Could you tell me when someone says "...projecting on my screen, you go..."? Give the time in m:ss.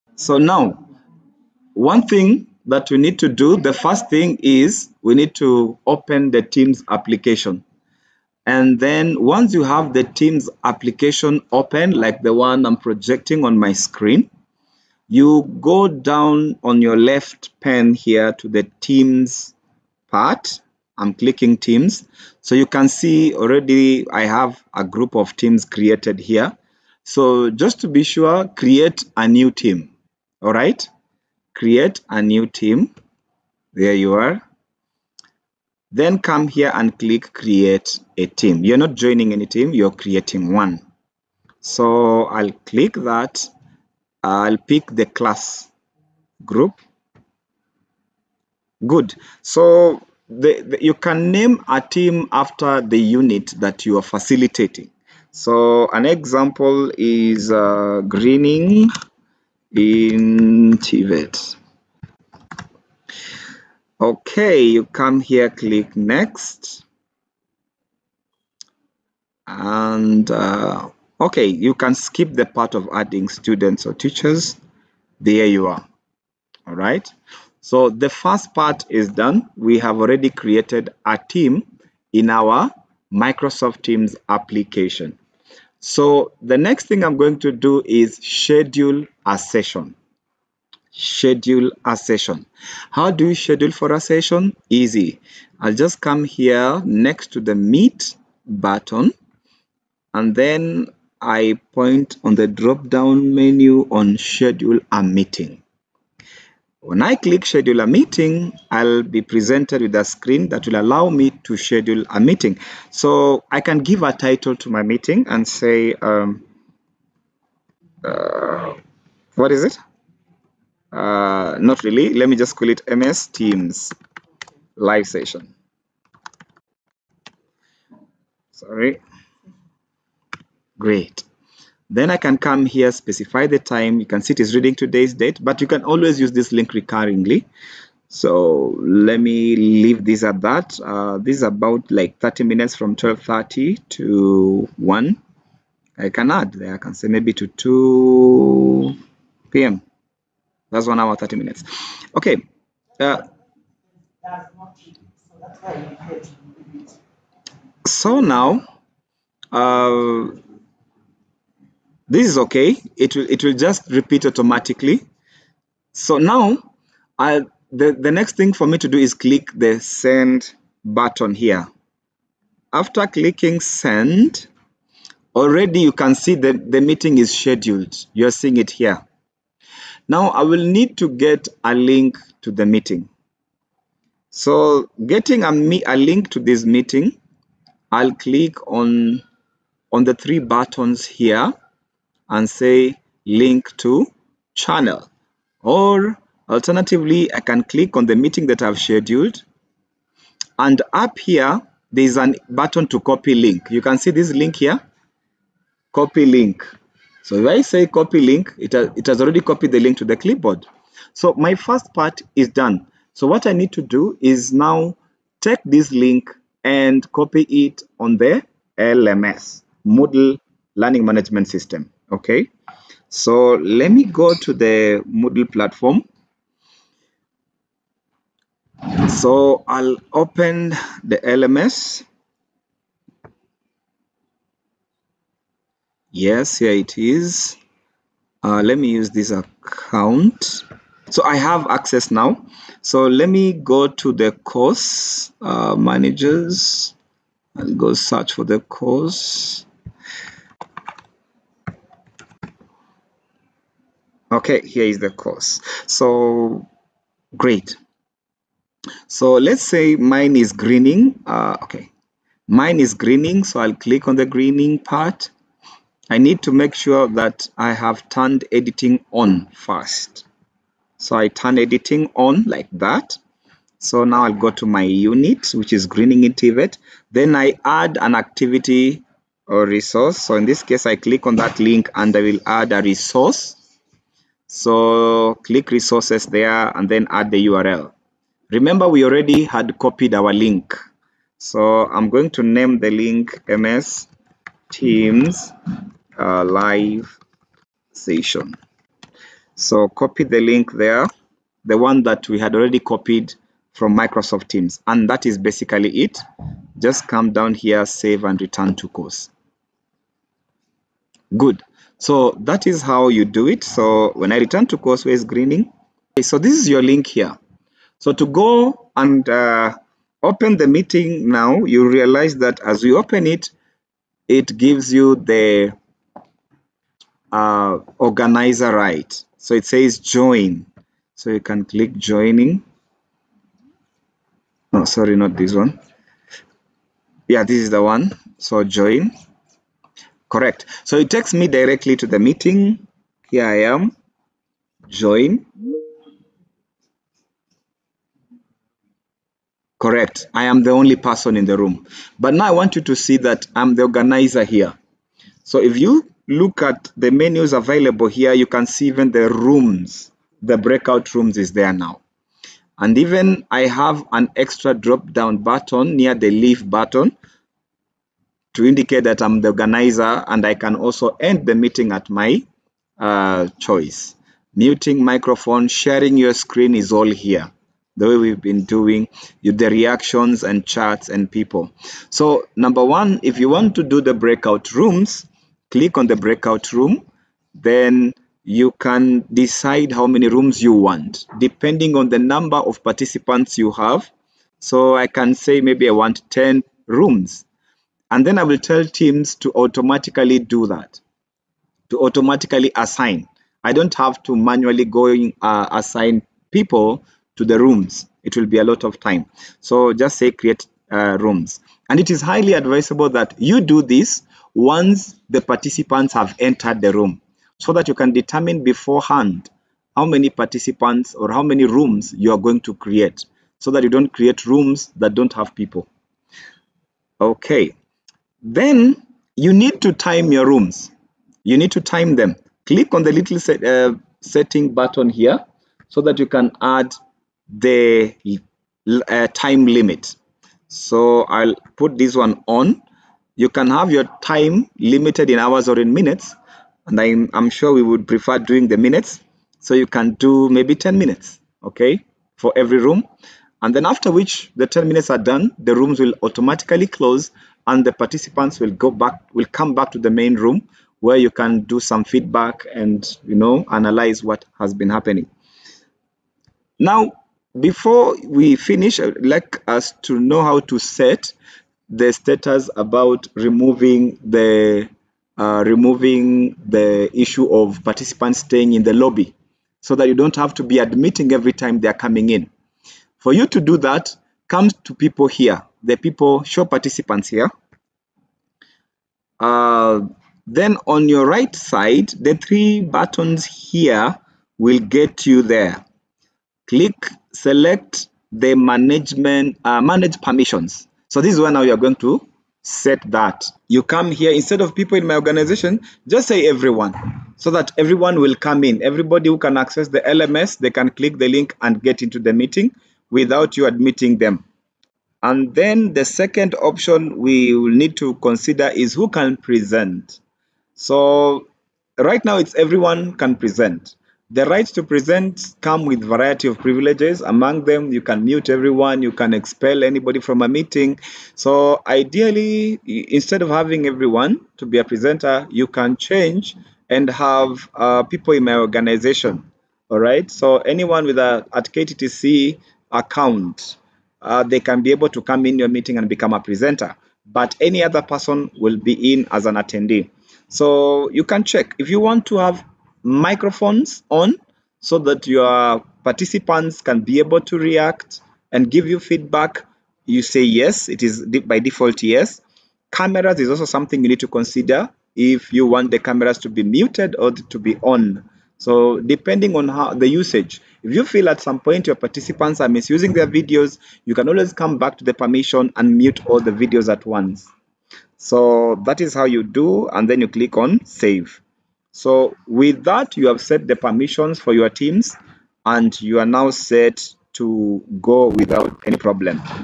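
0:12.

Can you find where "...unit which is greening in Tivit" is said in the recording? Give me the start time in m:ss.
4:34.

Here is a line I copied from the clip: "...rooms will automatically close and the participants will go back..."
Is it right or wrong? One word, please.
right.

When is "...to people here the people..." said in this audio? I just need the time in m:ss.
8:04.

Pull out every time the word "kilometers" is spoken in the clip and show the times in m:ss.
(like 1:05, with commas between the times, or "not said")
not said.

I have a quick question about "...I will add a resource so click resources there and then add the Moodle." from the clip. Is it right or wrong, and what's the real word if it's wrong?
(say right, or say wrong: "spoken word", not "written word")
wrong: "URL", not "Moodle".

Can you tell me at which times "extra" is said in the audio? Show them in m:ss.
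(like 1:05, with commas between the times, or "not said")
6:04.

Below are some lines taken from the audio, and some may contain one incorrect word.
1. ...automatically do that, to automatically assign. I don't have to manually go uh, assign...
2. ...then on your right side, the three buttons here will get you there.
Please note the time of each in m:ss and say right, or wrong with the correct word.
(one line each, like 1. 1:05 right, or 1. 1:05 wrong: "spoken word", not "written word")
1. 6:39 right
2. 8:10 right.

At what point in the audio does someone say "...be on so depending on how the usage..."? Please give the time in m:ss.
9:27.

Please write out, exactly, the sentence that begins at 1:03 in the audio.
Okay, you come here, click next.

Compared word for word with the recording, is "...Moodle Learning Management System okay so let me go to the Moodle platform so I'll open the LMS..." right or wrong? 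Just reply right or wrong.
right.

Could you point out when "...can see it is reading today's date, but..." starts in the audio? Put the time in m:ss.
2:14.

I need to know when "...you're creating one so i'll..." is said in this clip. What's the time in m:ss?
0:39.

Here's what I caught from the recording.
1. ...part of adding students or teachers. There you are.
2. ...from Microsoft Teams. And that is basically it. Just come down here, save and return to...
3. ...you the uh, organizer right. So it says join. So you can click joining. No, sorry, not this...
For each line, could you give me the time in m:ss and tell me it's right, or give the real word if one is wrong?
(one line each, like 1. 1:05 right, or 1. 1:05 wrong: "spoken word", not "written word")
1. 1:12 right
2. 5:03 right
3. 5:24 right.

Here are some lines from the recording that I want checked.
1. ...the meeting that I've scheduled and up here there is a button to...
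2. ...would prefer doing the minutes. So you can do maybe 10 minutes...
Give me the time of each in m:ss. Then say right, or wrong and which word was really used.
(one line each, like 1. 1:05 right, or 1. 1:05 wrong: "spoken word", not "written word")
1. 3:18 right
2. 7:27 right.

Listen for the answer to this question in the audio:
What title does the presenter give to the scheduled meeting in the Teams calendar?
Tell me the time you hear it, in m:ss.
2:02.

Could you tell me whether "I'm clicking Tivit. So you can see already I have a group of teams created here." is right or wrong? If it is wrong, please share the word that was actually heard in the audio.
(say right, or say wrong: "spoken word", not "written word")
wrong: "Teams", not "Tivit".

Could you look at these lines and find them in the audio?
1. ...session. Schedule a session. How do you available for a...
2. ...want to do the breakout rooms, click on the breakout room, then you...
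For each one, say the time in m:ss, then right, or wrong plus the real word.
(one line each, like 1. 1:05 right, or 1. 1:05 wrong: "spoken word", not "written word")
1. 1:29 wrong: "schedule", not "available"
2. 6:23 right.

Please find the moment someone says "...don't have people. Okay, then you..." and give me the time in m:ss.
7:05.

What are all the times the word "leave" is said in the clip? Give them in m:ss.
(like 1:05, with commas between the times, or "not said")
2:19, 6:06.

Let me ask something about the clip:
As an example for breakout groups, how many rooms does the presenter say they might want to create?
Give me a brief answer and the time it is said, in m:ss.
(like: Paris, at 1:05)
10, at 6:36.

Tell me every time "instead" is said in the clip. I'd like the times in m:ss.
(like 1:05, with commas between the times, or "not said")
8:24, 8:52.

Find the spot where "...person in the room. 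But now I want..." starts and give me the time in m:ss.
5:50.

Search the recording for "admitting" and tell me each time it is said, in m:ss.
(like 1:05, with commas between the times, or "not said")
8:00, 8:33.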